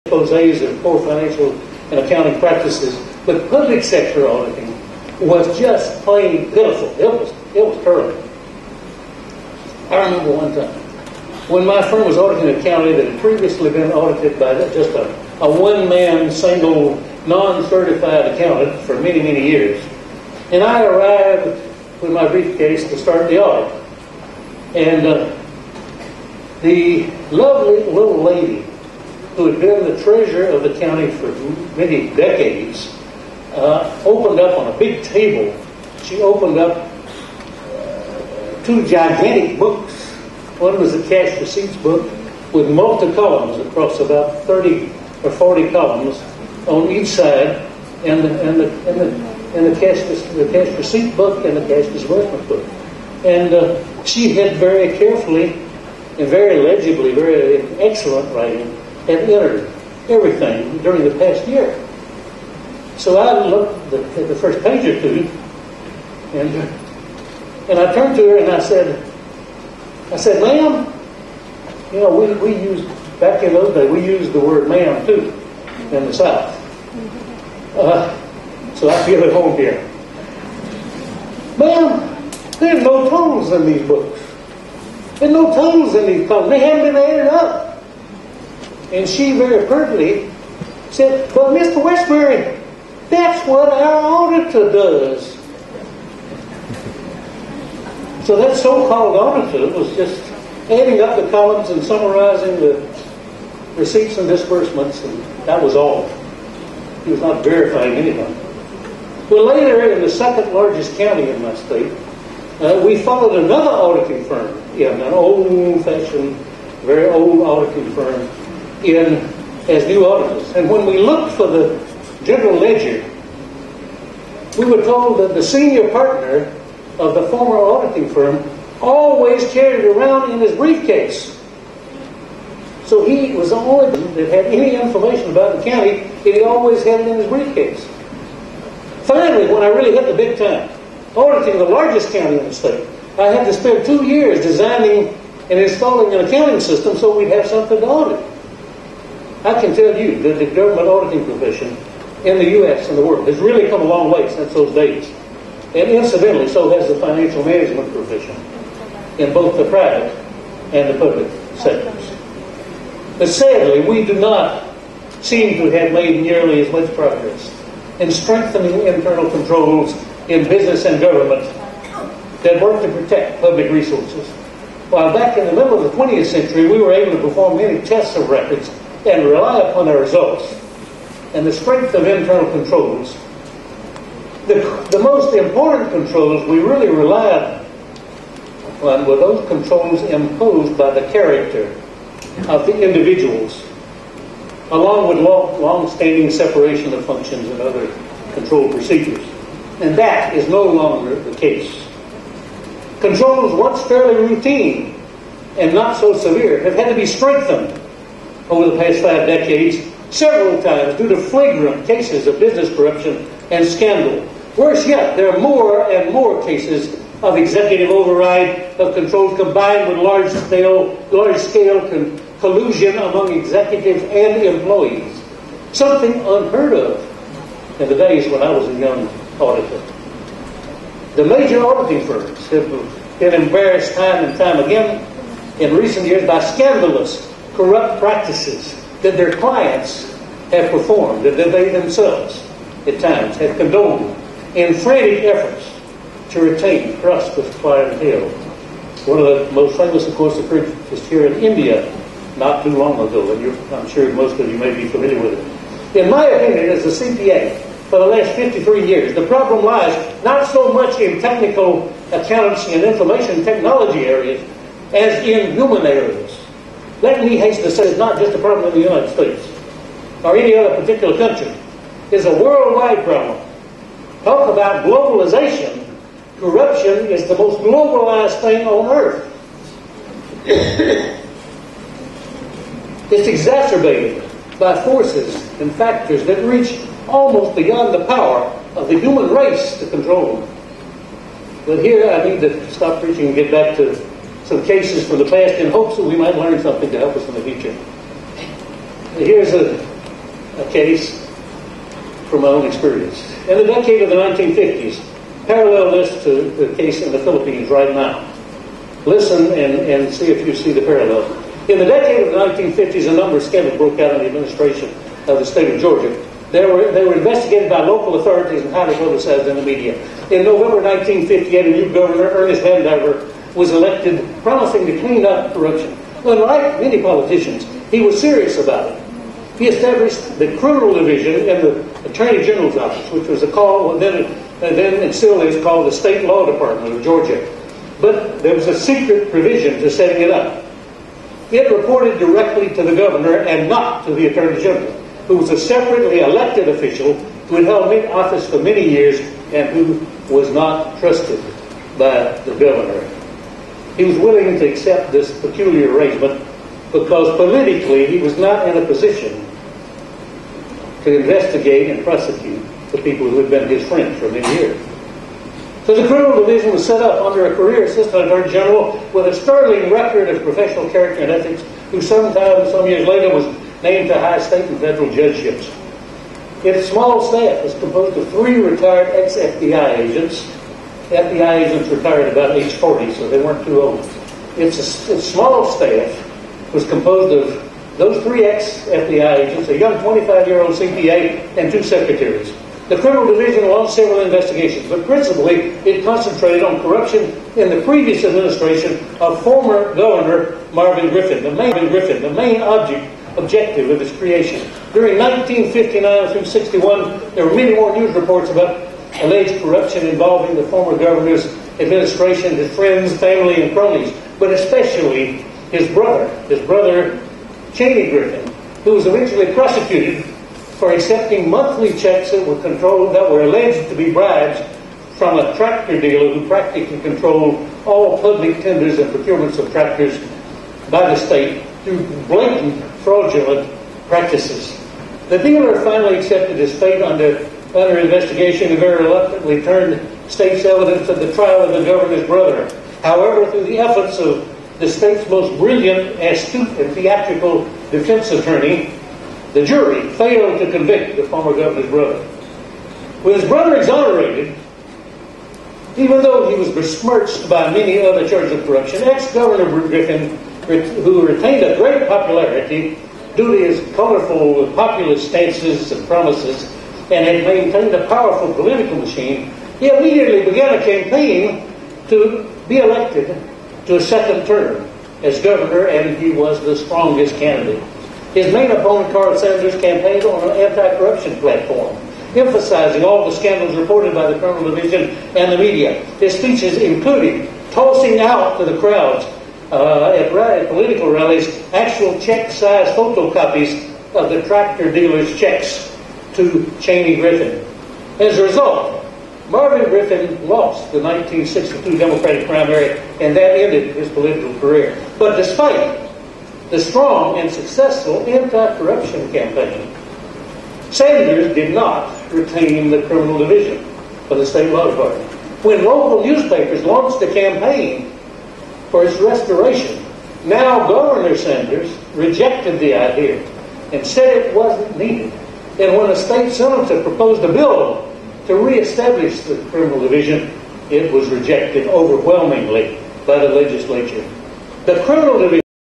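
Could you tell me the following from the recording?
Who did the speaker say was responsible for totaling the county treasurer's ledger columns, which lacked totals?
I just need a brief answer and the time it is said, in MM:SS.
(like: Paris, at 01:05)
our auditor, at 01:33.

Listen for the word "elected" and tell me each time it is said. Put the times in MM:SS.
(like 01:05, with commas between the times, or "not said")
05:23, 05:46, 07:52.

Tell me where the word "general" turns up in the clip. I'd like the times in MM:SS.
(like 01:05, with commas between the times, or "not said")
02:02, 05:32, 05:44, 06:08.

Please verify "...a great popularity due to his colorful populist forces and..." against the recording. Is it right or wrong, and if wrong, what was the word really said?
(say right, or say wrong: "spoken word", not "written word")
wrong: "stances", not "forces".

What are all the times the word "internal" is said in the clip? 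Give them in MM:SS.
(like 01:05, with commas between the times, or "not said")
02:48, 03:02.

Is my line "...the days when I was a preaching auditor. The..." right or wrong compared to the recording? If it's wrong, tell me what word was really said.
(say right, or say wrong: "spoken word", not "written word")
wrong: "young", not "preaching".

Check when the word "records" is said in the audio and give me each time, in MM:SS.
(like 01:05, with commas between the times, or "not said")
02:58, 06:09.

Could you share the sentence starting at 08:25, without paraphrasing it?
But despite the strong and successful anti-corruption campaign, Sanders did not retain the criminal division of the state law department.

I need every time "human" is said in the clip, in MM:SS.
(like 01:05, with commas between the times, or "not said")
04:25, 04:48.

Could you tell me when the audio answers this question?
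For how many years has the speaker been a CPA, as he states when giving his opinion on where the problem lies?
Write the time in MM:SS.
04:18.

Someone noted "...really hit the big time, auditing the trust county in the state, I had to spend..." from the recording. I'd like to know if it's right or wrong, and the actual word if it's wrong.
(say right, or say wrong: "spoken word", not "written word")
wrong: "largest", not "trust".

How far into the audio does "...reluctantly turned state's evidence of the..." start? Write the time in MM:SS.
07:19.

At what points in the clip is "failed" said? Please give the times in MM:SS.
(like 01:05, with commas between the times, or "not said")
07:30.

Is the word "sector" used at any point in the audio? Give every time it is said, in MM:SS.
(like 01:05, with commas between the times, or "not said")
00:03, 02:41.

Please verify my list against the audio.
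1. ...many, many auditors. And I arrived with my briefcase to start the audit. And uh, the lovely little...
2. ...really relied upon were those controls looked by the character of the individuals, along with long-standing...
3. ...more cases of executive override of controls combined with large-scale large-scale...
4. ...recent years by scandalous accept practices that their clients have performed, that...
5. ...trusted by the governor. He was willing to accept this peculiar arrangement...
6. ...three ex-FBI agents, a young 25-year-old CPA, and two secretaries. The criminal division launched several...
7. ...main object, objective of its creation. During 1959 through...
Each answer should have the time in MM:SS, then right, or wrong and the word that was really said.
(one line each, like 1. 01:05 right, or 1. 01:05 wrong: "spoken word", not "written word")
1. 00:19 wrong: "years", not "auditors"
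2. 03:06 wrong: "imposed", not "looked"
3. 03:36 right
4. 03:55 wrong: "corrupt", not "accept"
5. 05:50 right
6. 06:28 right
7. 06:42 right.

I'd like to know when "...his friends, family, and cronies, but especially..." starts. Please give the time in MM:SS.
06:52.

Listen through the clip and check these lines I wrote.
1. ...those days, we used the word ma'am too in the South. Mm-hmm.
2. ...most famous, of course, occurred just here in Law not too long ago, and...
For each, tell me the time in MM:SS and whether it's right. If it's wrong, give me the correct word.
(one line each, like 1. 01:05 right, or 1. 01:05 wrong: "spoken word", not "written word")
1. 01:13 right
2. 04:09 wrong: "India", not "Law".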